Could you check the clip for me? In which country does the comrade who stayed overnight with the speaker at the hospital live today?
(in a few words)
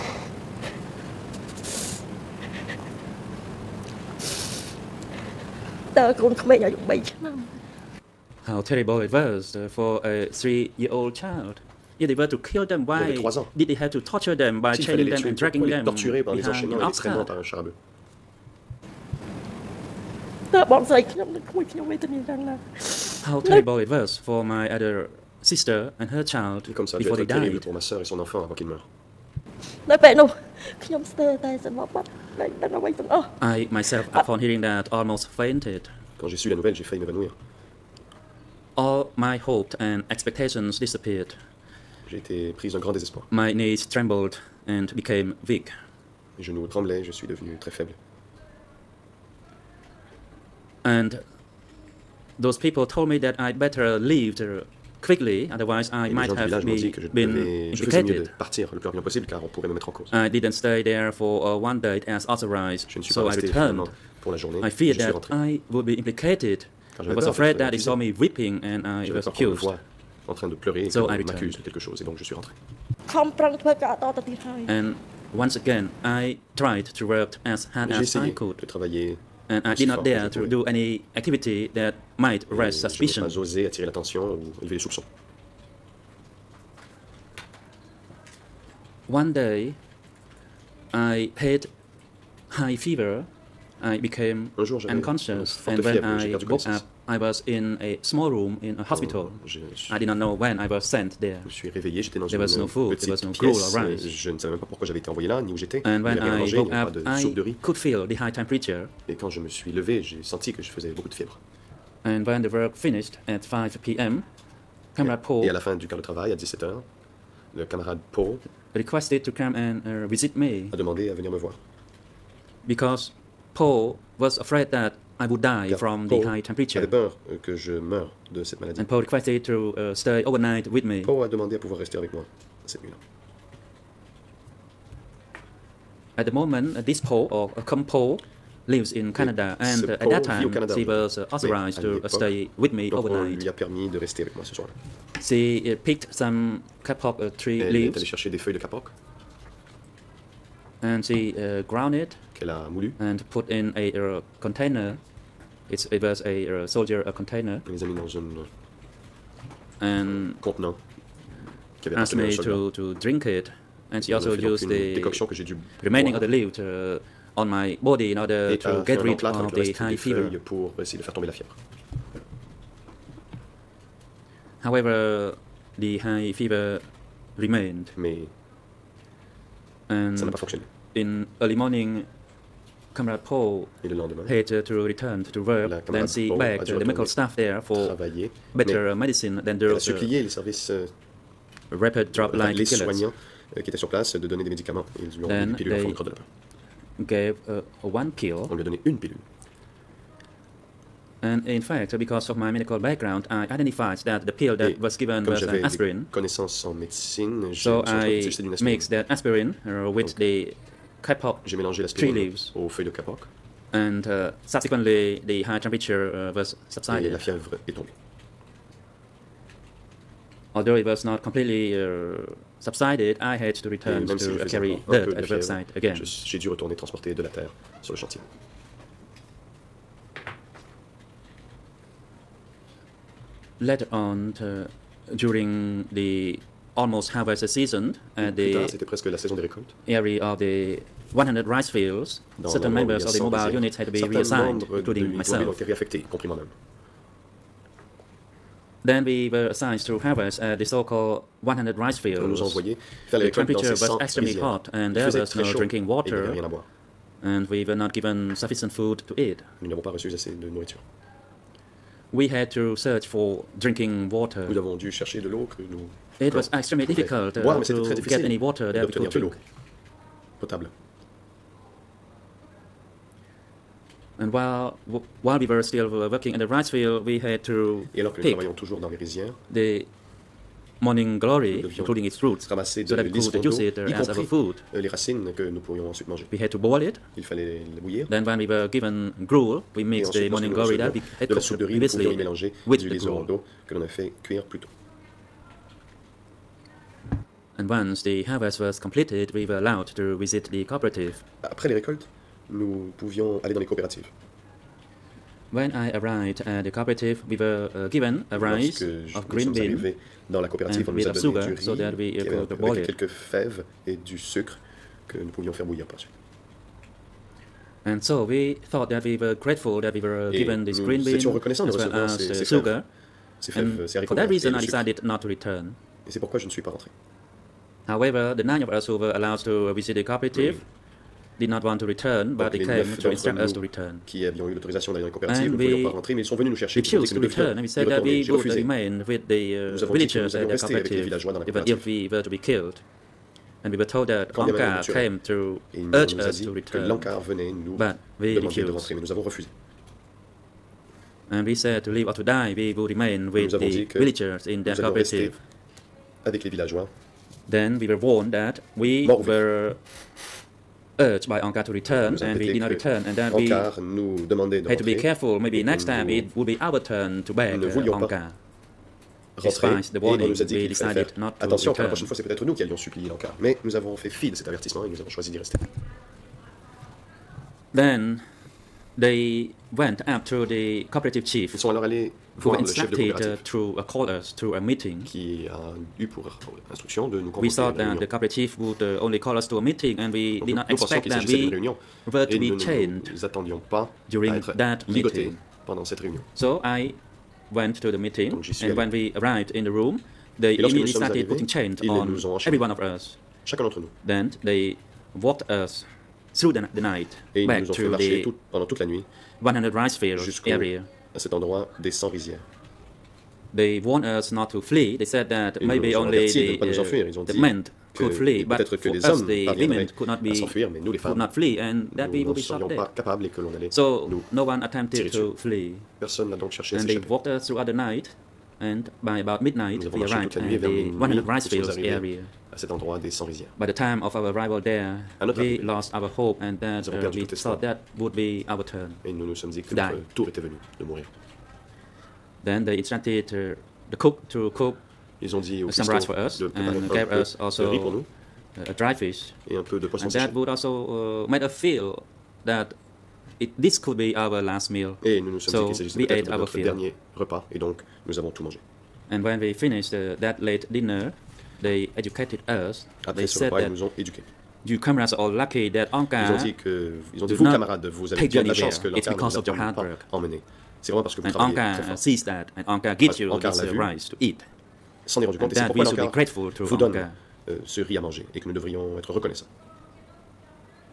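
Canada.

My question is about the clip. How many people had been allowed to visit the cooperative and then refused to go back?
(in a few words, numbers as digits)
9.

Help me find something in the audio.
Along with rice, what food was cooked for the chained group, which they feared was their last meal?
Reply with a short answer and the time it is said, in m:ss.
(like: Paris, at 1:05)
Dry fish, at 7:28.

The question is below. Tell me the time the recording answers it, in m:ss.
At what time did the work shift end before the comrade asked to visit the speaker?
1:53.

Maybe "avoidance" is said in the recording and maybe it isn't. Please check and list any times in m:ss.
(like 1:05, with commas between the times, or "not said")
not said.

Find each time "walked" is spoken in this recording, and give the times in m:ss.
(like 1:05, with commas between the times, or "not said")
6:45, 7:07.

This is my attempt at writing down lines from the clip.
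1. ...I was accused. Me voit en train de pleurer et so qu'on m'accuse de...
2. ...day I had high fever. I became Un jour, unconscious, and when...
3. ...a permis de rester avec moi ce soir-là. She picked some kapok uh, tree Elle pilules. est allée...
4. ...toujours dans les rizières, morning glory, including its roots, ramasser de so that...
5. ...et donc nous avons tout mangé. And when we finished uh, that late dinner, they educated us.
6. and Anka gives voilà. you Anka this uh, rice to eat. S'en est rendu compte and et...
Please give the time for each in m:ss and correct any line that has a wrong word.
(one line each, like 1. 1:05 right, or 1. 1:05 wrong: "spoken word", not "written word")
1. 1:08 right
2. 1:29 right
3. 2:23 wrong: "leaves", not "pilules"
4. 4:38 right
5. 7:37 right
6. 7:52 right.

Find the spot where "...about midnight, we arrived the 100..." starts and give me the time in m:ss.
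7:09.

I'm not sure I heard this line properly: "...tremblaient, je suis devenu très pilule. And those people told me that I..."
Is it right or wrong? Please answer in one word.
wrong.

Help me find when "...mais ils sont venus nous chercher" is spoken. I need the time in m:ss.
5:36.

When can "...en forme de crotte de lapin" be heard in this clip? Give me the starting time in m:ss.
3:15.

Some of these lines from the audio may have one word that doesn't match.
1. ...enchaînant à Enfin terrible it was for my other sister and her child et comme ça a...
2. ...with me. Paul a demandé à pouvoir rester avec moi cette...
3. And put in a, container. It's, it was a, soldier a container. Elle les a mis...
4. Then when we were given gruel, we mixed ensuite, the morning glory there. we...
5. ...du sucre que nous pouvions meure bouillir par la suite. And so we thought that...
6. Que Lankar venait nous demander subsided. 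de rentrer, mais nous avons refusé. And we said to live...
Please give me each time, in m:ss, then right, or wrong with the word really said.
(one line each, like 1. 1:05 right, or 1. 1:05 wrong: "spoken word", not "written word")
1. 0:16 wrong: "How", not "Enfin"
2. 2:10 right
3. 2:32 right
4. 4:48 right
5. 5:13 wrong: "faire", not "meure"
6. 5:46 wrong: "refused", not "subsided".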